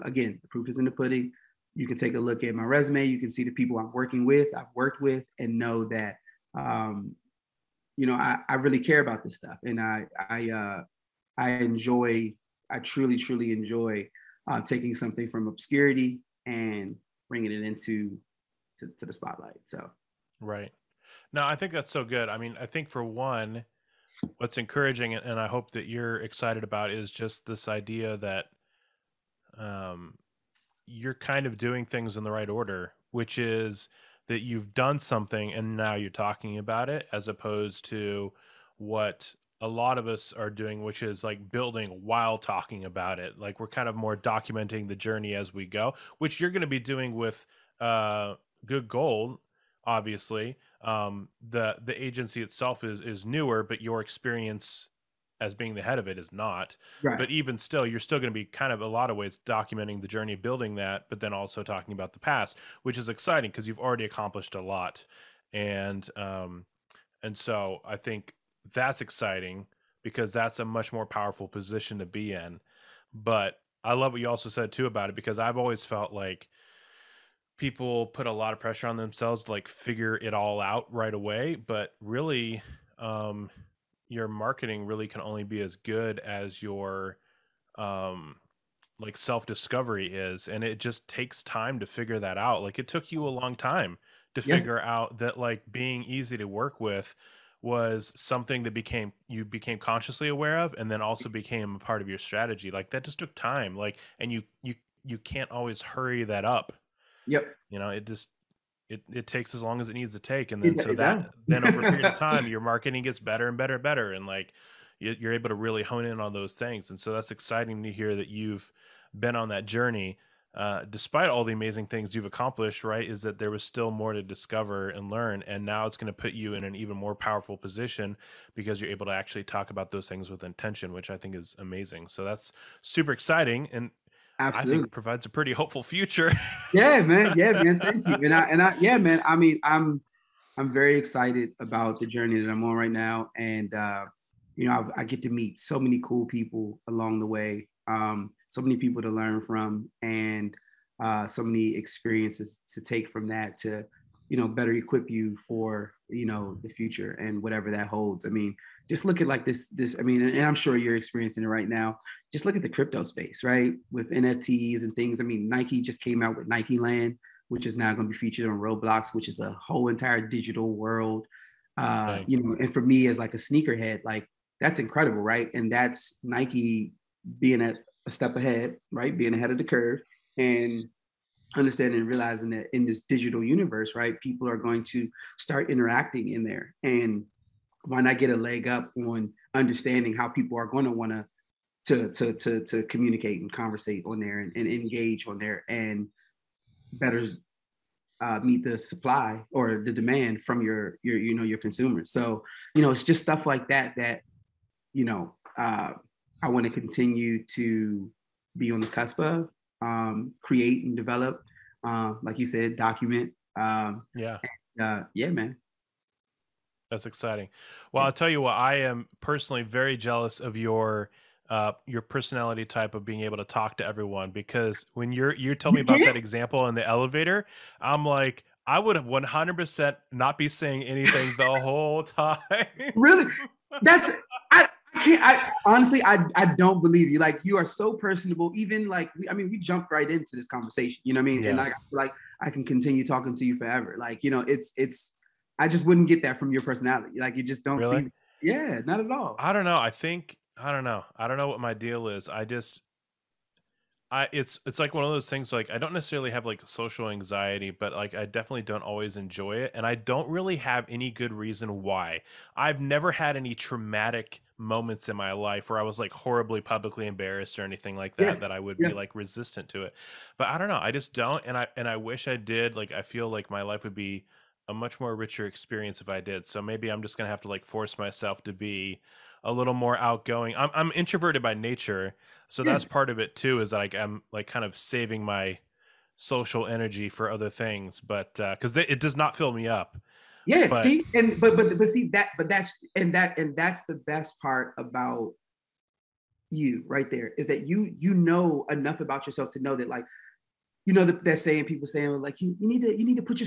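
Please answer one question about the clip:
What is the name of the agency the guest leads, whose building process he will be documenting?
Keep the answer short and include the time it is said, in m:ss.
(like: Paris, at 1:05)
Good Gold, at 0:48.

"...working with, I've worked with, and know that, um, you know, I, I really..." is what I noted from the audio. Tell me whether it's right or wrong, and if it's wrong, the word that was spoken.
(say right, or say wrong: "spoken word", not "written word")
right.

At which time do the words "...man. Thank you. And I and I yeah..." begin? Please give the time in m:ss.
2:17.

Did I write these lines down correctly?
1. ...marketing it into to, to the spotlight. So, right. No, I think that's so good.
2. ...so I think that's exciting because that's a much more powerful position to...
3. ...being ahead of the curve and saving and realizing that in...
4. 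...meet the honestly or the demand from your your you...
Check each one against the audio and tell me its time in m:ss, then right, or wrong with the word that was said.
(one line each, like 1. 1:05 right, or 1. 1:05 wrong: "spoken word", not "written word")
1. 0:17 wrong: "bringing", not "marketing"
2. 1:07 right
3. 2:59 wrong: "understanding", not "saving"
4. 3:18 wrong: "supply", not "honestly".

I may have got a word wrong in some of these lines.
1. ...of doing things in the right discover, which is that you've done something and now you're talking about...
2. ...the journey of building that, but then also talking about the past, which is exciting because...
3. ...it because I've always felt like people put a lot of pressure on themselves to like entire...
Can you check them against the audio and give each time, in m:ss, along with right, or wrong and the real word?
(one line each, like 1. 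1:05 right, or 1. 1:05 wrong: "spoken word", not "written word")
1. 0:31 wrong: "order", not "discover"
2. 1:00 right
3. 1:15 wrong: "figure", not "entire".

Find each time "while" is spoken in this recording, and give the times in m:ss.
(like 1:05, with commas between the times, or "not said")
0:42.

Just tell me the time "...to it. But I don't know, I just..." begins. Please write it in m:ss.
4:29.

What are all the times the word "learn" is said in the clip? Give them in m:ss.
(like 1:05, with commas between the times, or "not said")
2:05, 2:29.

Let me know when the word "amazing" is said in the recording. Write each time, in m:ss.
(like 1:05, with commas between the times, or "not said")
2:01, 2:11.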